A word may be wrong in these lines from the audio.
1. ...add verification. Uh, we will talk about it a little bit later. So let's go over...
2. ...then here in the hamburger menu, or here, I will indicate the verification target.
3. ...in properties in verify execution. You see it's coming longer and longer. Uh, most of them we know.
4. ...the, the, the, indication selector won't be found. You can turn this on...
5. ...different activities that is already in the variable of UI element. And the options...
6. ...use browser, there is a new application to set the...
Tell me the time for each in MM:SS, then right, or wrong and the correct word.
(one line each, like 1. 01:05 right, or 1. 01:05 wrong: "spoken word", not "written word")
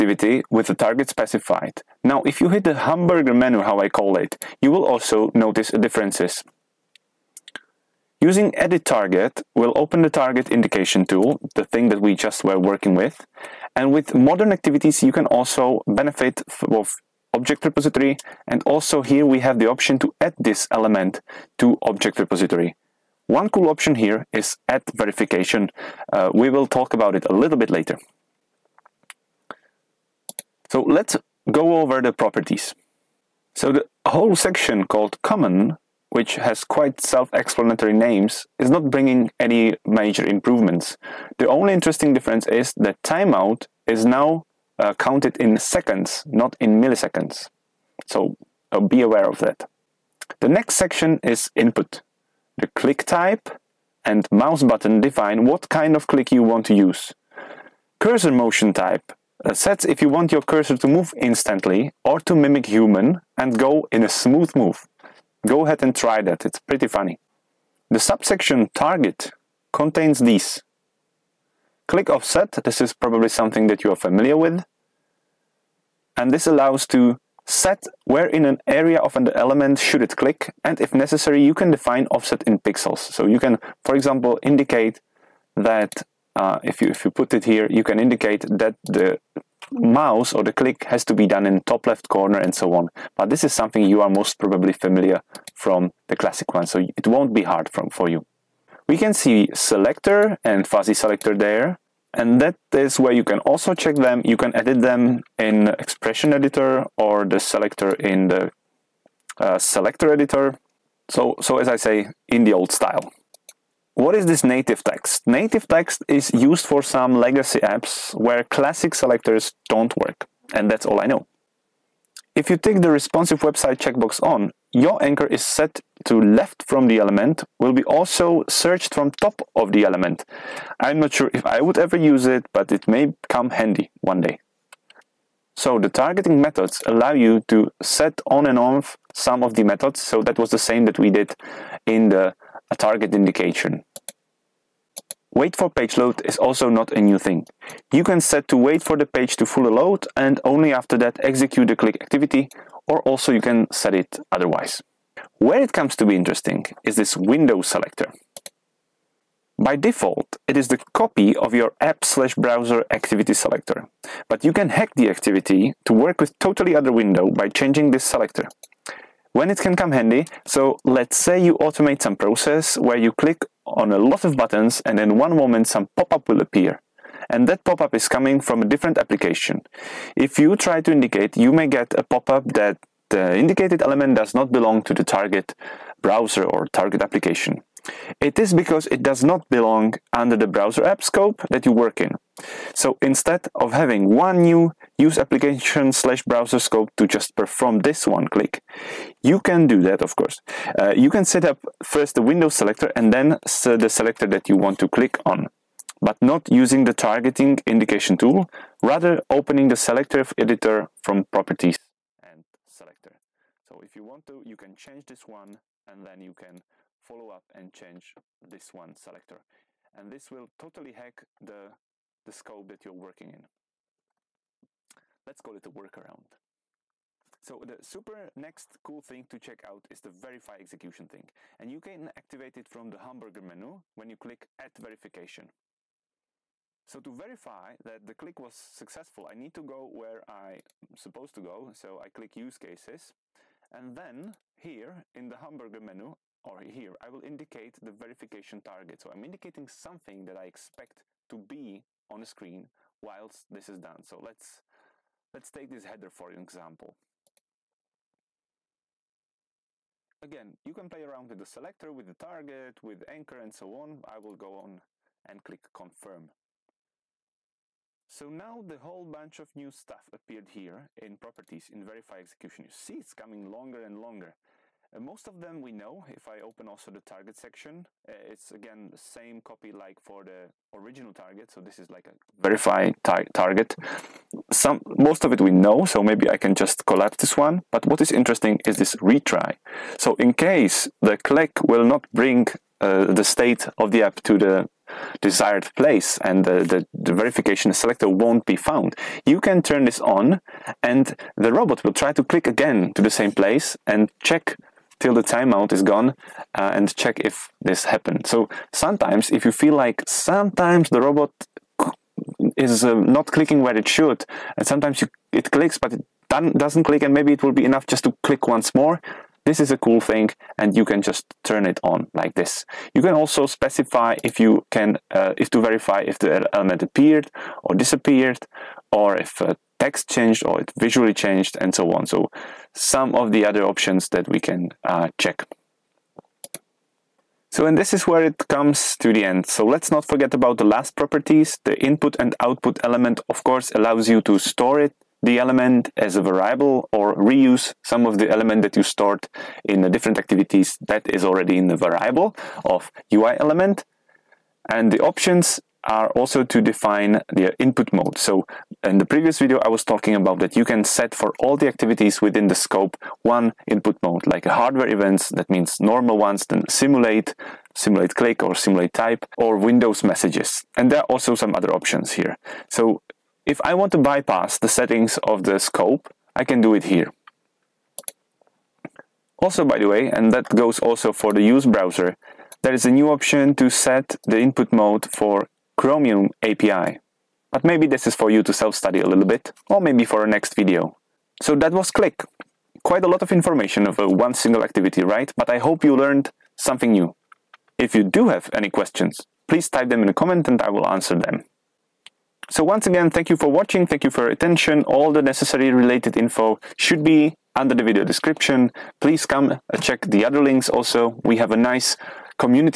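1. 00:24 right
2. 04:03 right
3. 04:30 right
4. 04:56 wrong: "verification", not "indication"
5. 05:49 right
6. 06:21 wrong: "option", not "application".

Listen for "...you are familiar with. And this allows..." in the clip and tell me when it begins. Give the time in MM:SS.
01:13.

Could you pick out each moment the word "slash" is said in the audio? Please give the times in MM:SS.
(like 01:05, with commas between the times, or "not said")
02:42, 03:15.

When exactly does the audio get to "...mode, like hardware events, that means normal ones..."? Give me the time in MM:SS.
06:04.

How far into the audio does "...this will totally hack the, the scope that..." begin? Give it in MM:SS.
03:40.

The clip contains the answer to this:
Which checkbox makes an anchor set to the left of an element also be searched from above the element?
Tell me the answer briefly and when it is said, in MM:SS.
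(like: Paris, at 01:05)
responsive website, at 02:02.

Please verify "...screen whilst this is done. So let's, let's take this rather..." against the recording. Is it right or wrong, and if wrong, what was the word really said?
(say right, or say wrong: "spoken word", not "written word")
wrong: "header", not "rather".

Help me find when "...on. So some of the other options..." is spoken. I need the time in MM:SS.
05:31.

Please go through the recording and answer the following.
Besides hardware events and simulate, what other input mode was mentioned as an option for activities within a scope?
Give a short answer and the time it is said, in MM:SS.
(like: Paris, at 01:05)
Windows messages, at 06:09.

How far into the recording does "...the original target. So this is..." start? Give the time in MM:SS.
04:40.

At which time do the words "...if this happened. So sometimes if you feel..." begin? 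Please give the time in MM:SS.
05:07.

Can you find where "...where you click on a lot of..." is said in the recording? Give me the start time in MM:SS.
02:52.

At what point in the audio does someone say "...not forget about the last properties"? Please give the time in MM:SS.
05:39.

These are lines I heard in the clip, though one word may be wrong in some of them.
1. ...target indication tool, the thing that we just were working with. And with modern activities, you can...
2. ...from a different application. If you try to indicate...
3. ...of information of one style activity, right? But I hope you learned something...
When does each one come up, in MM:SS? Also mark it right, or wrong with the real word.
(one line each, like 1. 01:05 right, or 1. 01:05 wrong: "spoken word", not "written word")
1. 00:10 right
2. 02:58 right
3. 06:33 wrong: "single", not "style".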